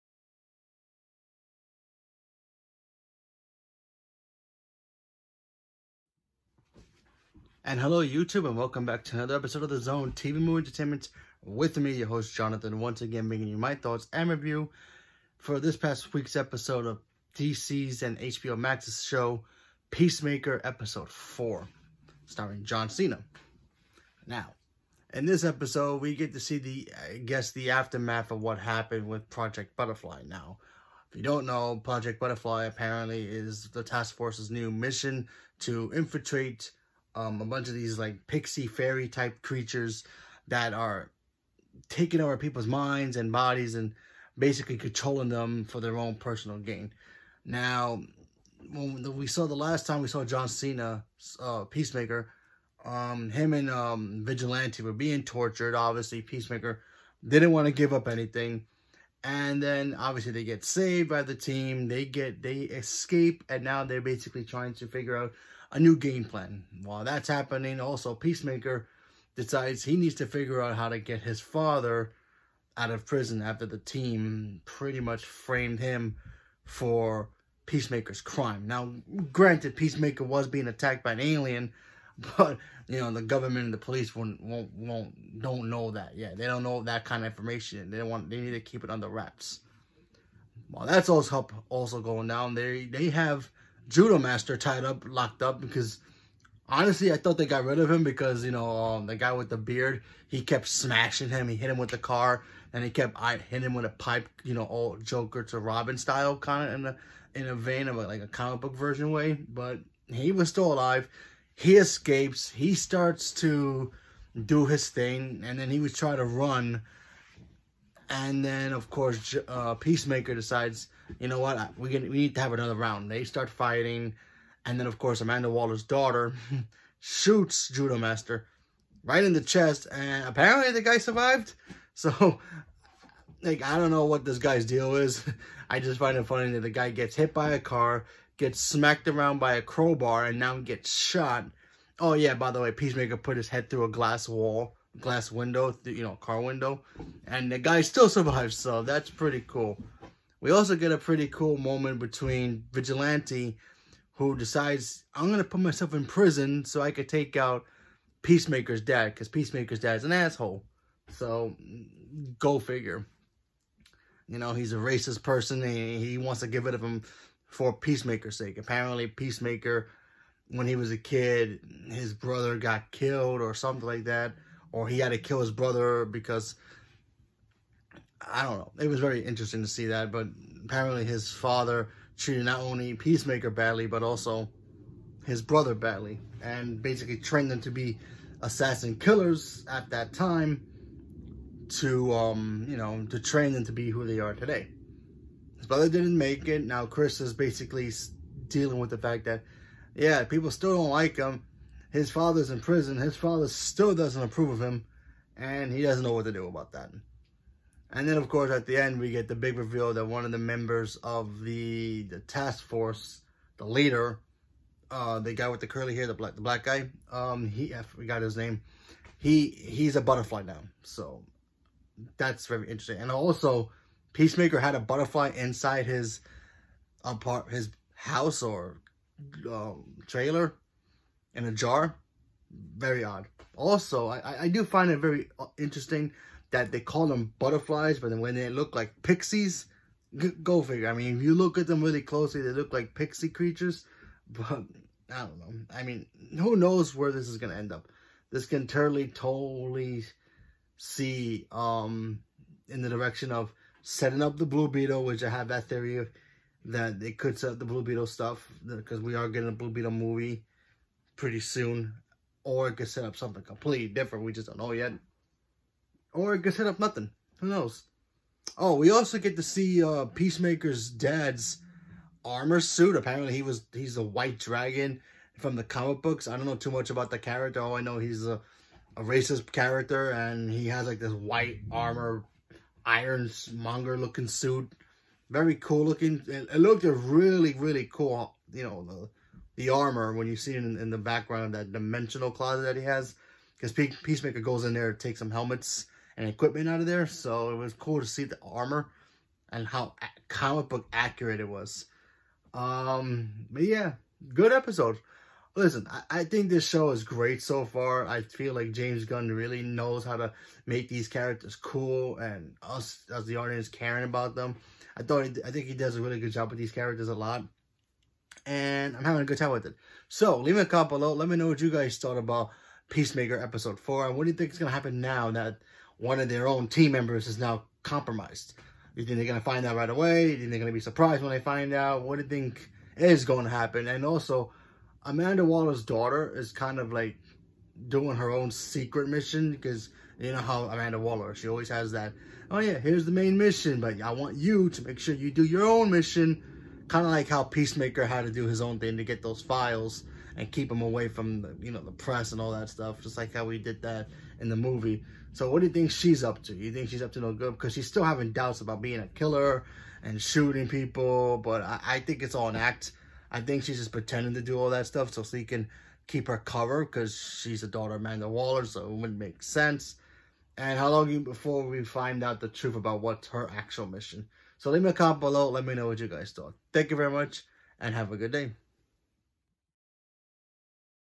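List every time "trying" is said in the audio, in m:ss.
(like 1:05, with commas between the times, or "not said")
1:04, 1:55.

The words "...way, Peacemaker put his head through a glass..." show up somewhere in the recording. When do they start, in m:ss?
2:22.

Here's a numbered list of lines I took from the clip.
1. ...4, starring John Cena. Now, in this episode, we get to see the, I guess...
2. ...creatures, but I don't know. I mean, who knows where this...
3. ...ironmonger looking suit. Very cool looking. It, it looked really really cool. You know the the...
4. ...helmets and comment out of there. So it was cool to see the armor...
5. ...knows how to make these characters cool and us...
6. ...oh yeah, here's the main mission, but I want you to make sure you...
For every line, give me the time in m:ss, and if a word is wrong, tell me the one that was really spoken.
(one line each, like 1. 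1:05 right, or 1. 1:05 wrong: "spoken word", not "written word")
1. 0:21 right
2. 4:03 right
3. 4:42 right
4. 4:55 wrong: "equipment", not "comment"
5. 5:09 right
6. 5:42 right.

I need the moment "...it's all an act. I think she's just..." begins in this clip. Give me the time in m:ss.
6:02.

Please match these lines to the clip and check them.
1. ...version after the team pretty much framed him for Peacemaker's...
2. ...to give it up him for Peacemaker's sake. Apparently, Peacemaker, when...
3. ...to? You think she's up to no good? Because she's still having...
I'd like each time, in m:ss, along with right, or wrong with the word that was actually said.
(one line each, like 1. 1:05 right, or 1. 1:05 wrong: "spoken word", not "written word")
1. 1:13 wrong: "prison", not "version"
2. 2:46 right
3. 5:56 right.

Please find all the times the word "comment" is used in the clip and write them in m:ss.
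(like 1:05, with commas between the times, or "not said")
5:20, 6:14.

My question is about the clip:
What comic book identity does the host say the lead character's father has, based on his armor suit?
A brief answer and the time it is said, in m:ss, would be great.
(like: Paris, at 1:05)
White Dragon, at 4:34.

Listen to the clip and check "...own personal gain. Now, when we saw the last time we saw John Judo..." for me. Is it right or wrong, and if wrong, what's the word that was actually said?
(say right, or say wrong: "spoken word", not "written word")
wrong: "Cena", not "Judo".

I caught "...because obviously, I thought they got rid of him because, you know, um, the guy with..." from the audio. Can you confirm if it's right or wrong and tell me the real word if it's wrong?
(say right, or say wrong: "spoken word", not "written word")
wrong: "honestly", not "obviously".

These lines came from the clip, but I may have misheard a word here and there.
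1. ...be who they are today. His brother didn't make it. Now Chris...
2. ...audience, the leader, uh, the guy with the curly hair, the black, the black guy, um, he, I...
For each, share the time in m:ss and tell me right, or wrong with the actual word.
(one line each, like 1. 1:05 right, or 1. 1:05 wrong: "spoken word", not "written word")
1. 3:13 right
2. 3:32 wrong: "force", not "audience".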